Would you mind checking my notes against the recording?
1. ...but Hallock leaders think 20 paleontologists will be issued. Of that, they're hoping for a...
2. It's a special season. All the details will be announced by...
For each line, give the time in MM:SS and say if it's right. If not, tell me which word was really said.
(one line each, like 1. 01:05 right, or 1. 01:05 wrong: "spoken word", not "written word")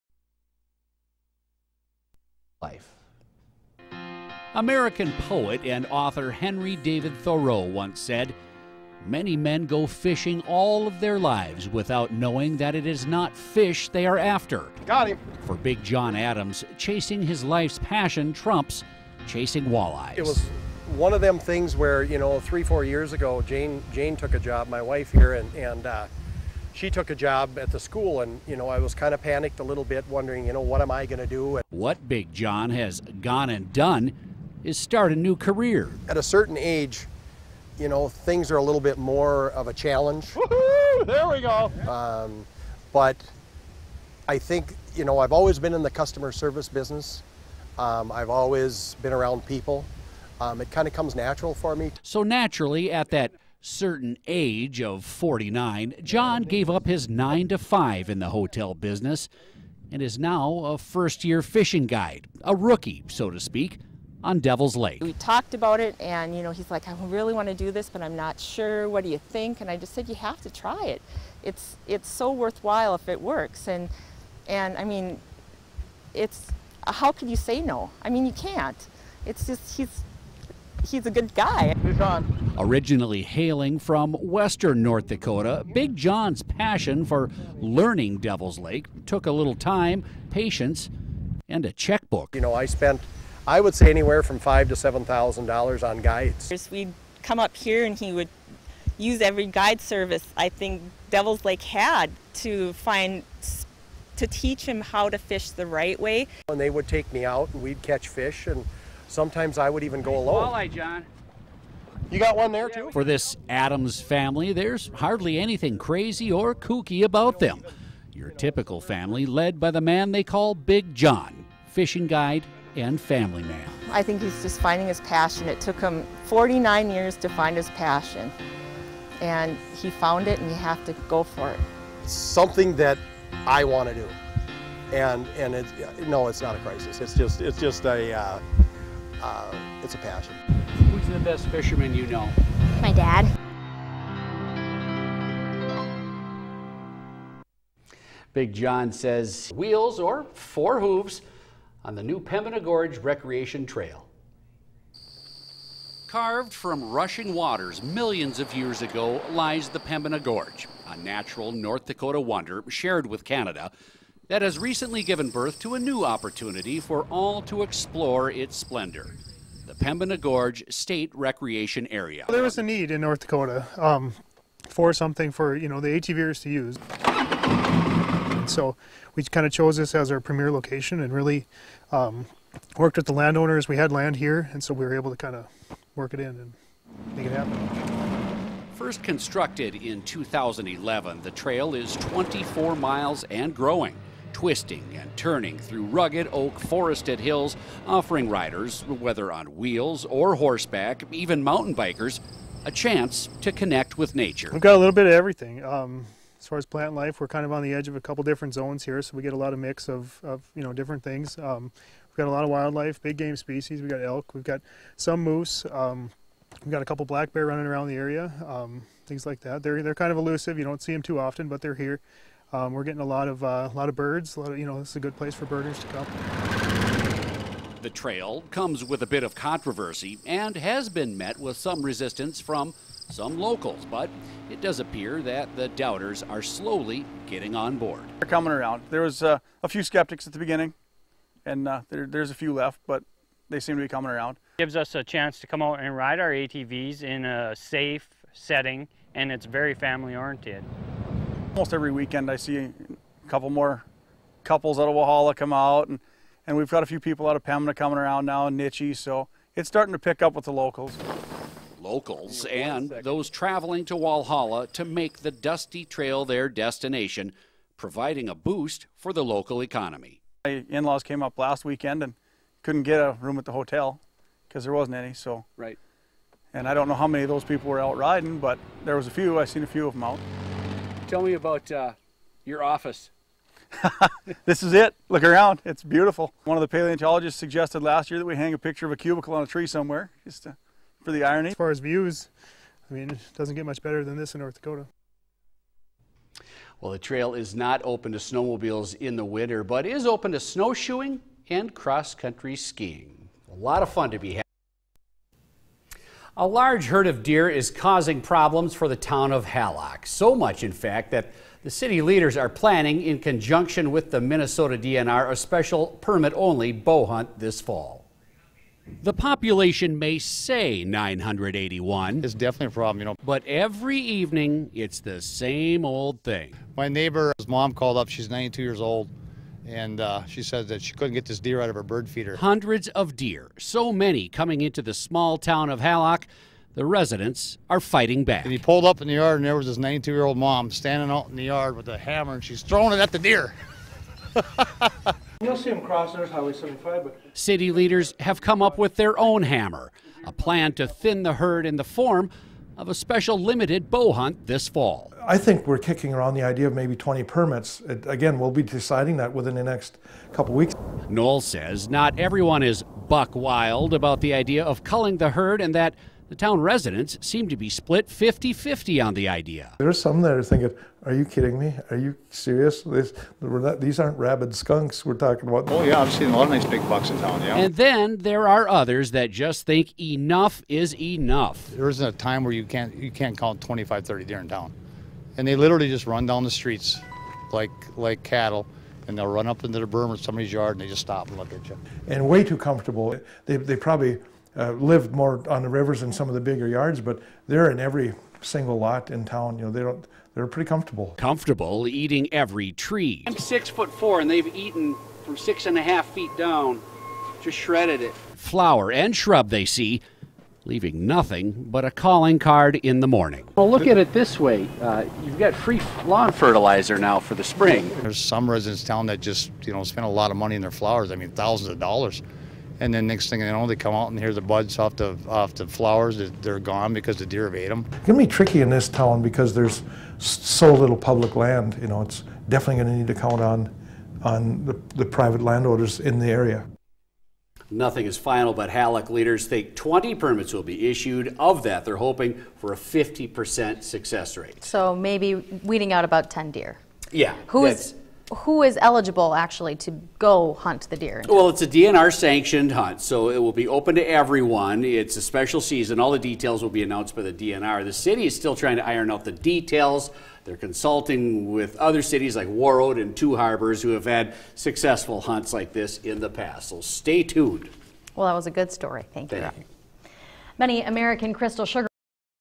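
1. 07:18 wrong: "permits", not "paleontologists"
2. 07:34 right.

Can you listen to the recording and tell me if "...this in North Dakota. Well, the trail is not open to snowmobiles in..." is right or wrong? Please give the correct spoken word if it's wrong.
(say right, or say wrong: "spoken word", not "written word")
right.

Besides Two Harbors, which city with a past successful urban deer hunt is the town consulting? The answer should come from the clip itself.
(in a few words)
Warroad.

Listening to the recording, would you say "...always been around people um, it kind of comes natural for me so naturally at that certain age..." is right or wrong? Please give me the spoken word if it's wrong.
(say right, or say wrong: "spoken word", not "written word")
right.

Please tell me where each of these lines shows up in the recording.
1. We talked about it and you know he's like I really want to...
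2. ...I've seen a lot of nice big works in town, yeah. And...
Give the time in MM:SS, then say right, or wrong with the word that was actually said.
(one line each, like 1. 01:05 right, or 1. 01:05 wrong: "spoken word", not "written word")
1. 01:05 right
2. 06:16 wrong: "bucks", not "works".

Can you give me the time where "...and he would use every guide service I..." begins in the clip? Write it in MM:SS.
01:37.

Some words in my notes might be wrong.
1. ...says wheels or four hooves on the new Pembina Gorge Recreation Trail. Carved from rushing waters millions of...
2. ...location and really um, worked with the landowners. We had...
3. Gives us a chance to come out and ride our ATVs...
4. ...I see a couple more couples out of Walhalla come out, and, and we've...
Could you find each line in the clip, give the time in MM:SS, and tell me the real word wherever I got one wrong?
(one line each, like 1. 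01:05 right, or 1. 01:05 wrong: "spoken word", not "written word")
1. 02:28 right
2. 03:00 right
3. 04:04 right
4. 04:12 right.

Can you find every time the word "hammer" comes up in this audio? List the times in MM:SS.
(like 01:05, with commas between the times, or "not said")
05:41, 05:49.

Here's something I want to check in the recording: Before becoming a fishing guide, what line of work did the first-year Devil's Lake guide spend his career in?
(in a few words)
Hotel business.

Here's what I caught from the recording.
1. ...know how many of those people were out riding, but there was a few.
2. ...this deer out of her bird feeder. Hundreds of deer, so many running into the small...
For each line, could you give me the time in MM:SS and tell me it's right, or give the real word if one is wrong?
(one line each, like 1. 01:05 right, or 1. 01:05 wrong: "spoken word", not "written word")
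1. 04:36 right
2. 05:31 wrong: "coming", not "running".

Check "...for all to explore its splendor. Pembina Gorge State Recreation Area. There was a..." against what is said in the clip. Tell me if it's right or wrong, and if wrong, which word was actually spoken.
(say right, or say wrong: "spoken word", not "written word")
right.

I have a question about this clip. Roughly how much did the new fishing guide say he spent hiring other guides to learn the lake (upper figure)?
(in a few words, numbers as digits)
$7,000.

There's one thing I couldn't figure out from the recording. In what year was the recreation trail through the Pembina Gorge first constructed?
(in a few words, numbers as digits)
2011.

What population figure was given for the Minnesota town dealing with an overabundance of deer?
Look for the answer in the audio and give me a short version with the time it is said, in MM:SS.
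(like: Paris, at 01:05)
981, at 05:20.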